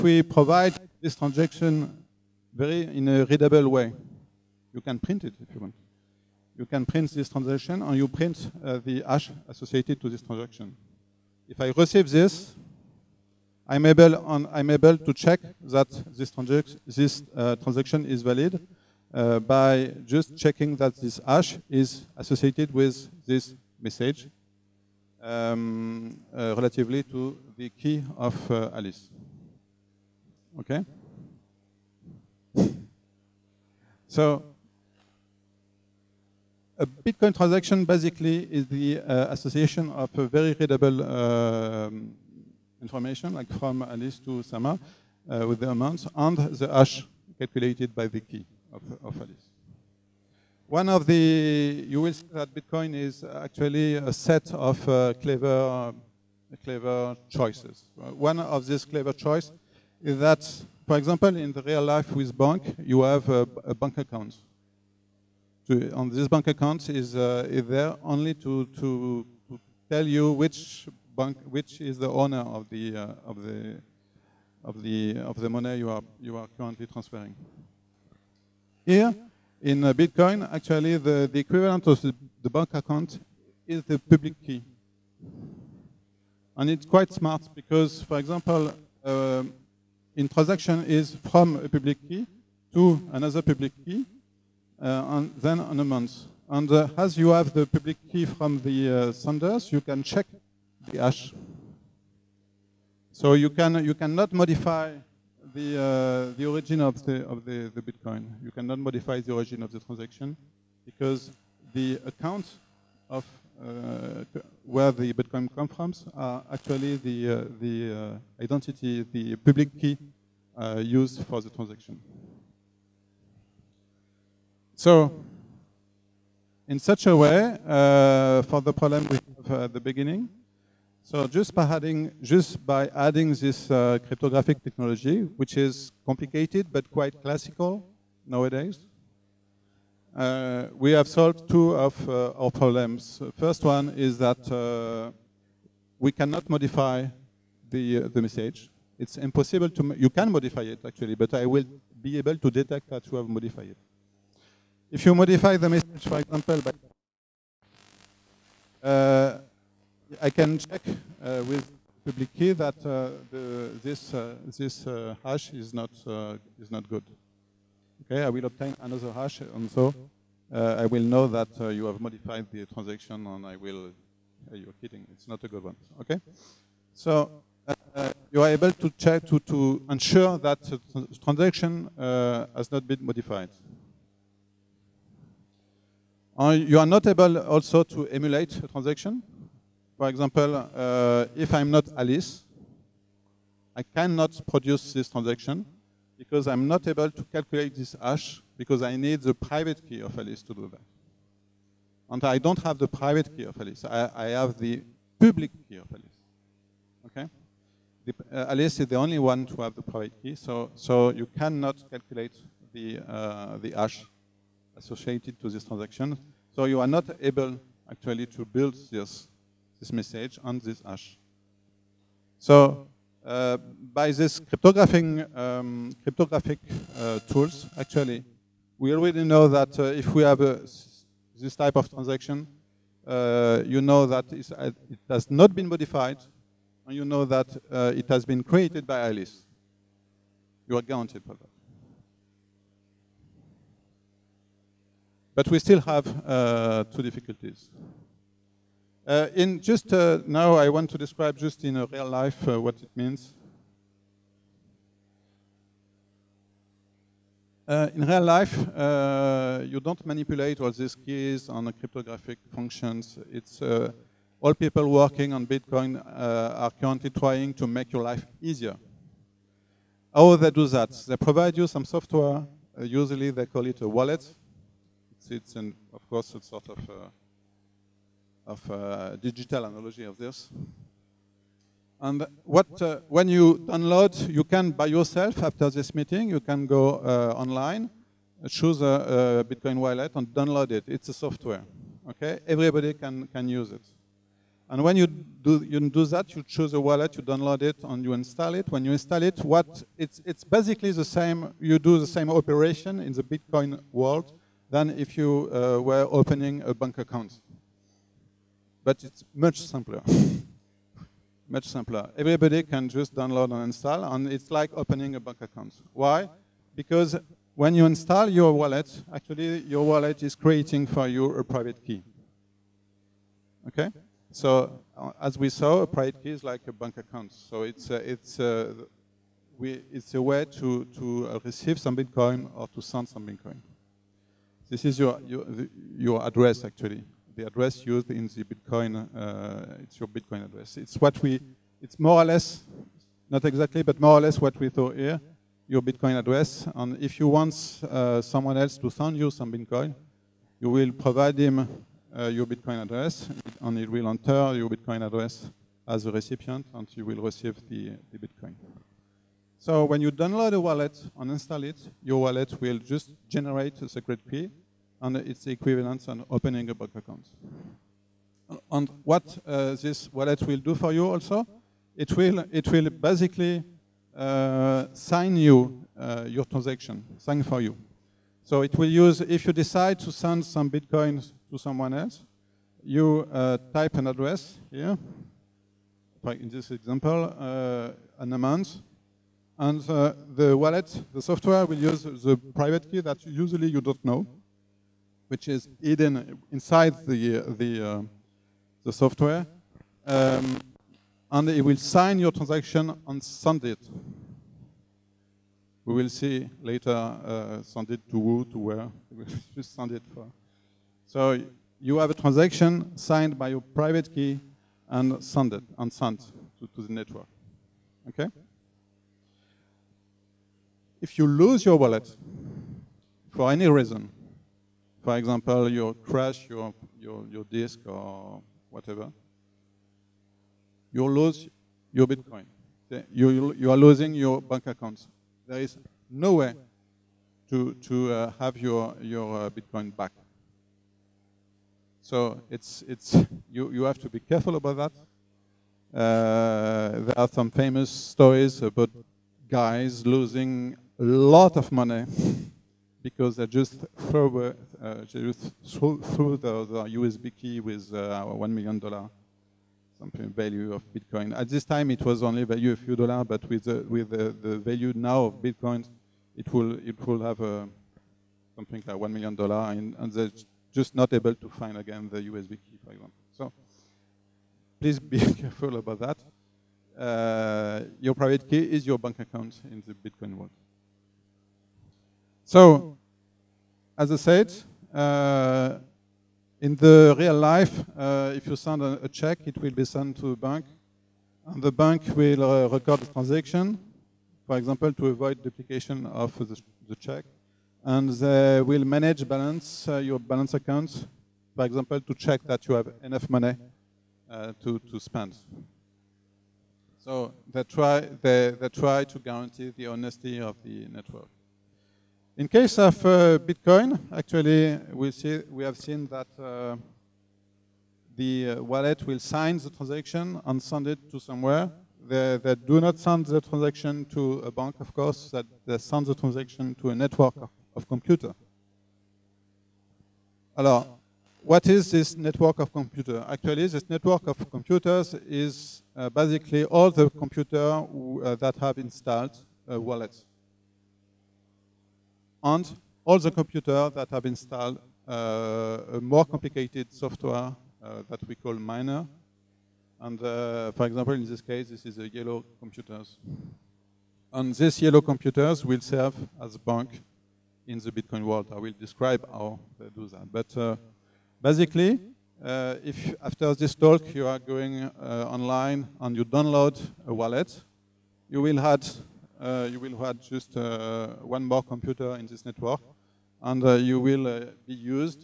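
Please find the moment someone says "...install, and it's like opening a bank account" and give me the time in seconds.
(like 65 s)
313 s.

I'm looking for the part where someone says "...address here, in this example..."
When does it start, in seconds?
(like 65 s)
384 s.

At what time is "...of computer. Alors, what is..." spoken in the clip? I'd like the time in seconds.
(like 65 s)
527 s.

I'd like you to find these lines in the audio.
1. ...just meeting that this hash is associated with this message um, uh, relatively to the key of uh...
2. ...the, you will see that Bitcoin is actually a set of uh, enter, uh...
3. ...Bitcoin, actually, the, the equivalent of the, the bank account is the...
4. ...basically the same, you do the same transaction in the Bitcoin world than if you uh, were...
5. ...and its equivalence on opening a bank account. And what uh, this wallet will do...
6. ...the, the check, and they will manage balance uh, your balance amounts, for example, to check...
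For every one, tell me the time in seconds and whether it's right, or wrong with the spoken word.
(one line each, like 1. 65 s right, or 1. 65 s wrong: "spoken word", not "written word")
1. 20 s wrong: "checking", not "meeting"
2. 51 s wrong: "clever", not "enter"
3. 79 s right
4. 300 s wrong: "operation", not "transaction"
5. 365 s right
6. 496 s wrong: "accounts", not "amounts".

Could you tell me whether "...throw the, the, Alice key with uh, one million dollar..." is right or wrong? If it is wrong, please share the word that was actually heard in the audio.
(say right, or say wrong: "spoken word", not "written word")
wrong: "USB", not "Alice".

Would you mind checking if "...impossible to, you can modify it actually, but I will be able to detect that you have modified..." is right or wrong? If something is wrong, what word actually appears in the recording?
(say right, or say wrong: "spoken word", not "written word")
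right.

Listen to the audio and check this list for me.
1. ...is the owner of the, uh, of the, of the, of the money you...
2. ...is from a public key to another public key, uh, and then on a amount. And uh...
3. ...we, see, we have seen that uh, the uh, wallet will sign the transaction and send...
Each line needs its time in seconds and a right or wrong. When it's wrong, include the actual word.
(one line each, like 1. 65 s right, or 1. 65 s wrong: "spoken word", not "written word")
1. 71 s right
2. 90 s right
3. 514 s right.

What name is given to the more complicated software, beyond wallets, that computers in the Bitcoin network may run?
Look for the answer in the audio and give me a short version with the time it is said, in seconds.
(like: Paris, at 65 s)
Miner, at 548 s.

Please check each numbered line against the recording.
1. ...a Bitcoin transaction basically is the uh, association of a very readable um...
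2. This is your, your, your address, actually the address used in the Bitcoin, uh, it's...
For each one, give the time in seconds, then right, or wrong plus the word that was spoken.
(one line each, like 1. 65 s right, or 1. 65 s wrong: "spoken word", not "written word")
1. 36 s right
2. 334 s right.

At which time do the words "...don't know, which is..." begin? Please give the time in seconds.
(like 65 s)
393 s.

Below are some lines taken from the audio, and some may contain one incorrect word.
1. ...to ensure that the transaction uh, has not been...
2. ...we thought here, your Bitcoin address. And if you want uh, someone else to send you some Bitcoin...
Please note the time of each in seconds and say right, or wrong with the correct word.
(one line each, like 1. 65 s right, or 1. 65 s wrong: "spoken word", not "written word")
1. 179 s right
2. 344 s right.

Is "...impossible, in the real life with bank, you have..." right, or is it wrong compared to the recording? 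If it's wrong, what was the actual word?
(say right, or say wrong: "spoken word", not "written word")
wrong: "example", not "impossible".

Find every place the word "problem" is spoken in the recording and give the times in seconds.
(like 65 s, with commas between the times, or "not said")
128 s, 142 s.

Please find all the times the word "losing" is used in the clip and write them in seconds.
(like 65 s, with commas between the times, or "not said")
433 s, 450 s.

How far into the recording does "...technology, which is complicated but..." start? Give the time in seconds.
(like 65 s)
134 s.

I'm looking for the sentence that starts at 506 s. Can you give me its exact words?
So they try they, they try to guarantee the honesty of the network.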